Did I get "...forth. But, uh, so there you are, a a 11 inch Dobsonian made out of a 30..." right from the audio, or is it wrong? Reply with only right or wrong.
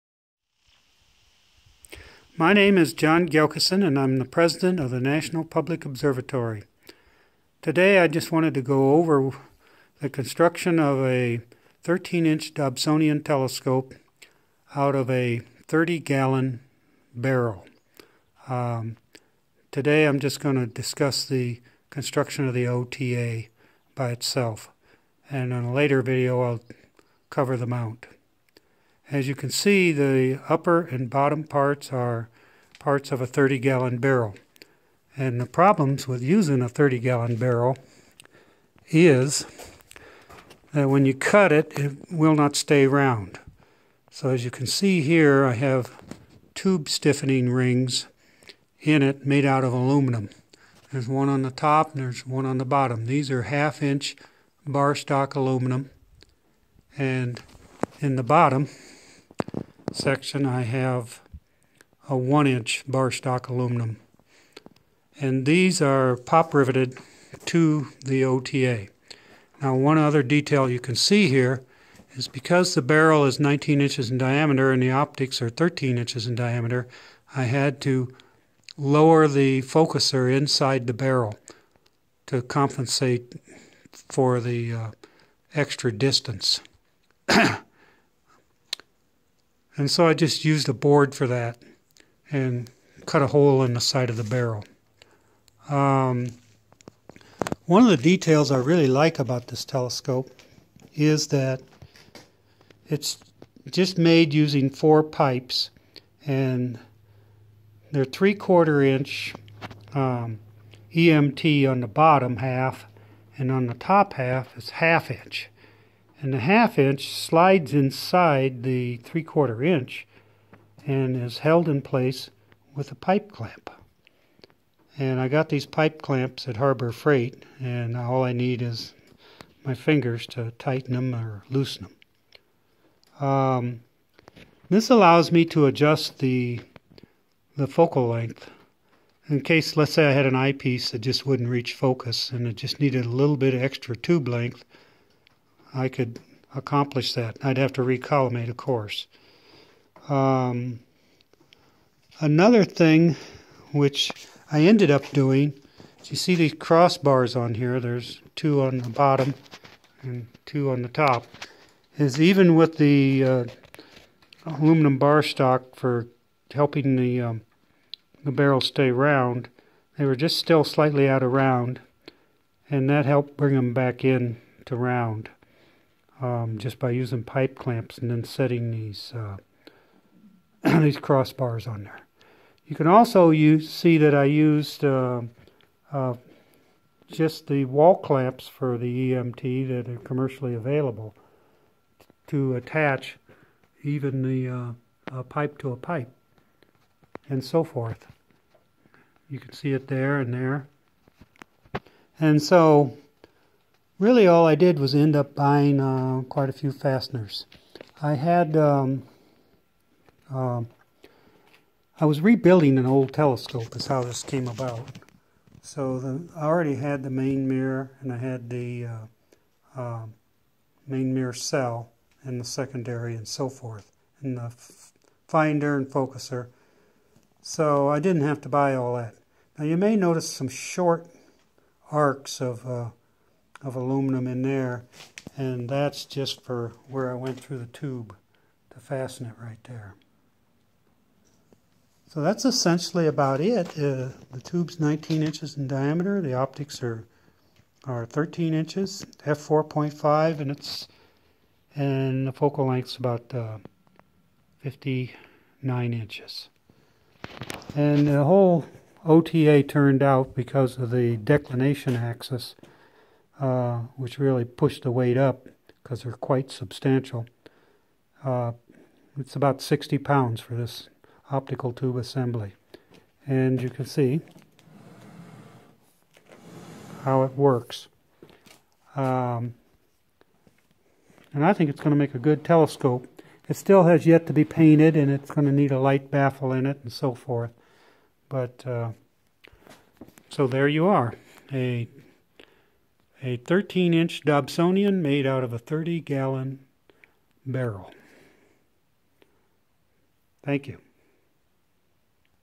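wrong.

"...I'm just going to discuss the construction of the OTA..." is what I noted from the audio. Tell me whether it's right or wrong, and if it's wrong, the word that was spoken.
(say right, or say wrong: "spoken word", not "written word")
right.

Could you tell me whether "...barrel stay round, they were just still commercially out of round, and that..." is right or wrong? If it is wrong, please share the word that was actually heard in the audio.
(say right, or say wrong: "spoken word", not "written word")
wrong: "slightly", not "commercially".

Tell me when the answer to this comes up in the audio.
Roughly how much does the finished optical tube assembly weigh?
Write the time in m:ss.
4:29.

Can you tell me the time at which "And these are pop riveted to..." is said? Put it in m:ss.
1:05.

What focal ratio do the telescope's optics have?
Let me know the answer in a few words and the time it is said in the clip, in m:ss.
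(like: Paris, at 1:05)
f4.5, at 4:09.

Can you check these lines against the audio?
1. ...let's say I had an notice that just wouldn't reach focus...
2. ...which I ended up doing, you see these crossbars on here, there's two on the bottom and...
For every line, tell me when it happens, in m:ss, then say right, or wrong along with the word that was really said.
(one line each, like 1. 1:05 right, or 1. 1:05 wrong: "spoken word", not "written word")
1. 2:19 wrong: "eyepiece", not "notice"
2. 2:33 right.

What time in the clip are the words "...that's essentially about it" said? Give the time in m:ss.
4:02.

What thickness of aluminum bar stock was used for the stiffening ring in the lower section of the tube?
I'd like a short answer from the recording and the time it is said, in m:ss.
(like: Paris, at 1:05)
1 inch, at 1:02.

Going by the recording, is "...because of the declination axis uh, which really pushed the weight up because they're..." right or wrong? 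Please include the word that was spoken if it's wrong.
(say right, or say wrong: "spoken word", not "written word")
right.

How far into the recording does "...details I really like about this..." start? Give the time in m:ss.
1:37.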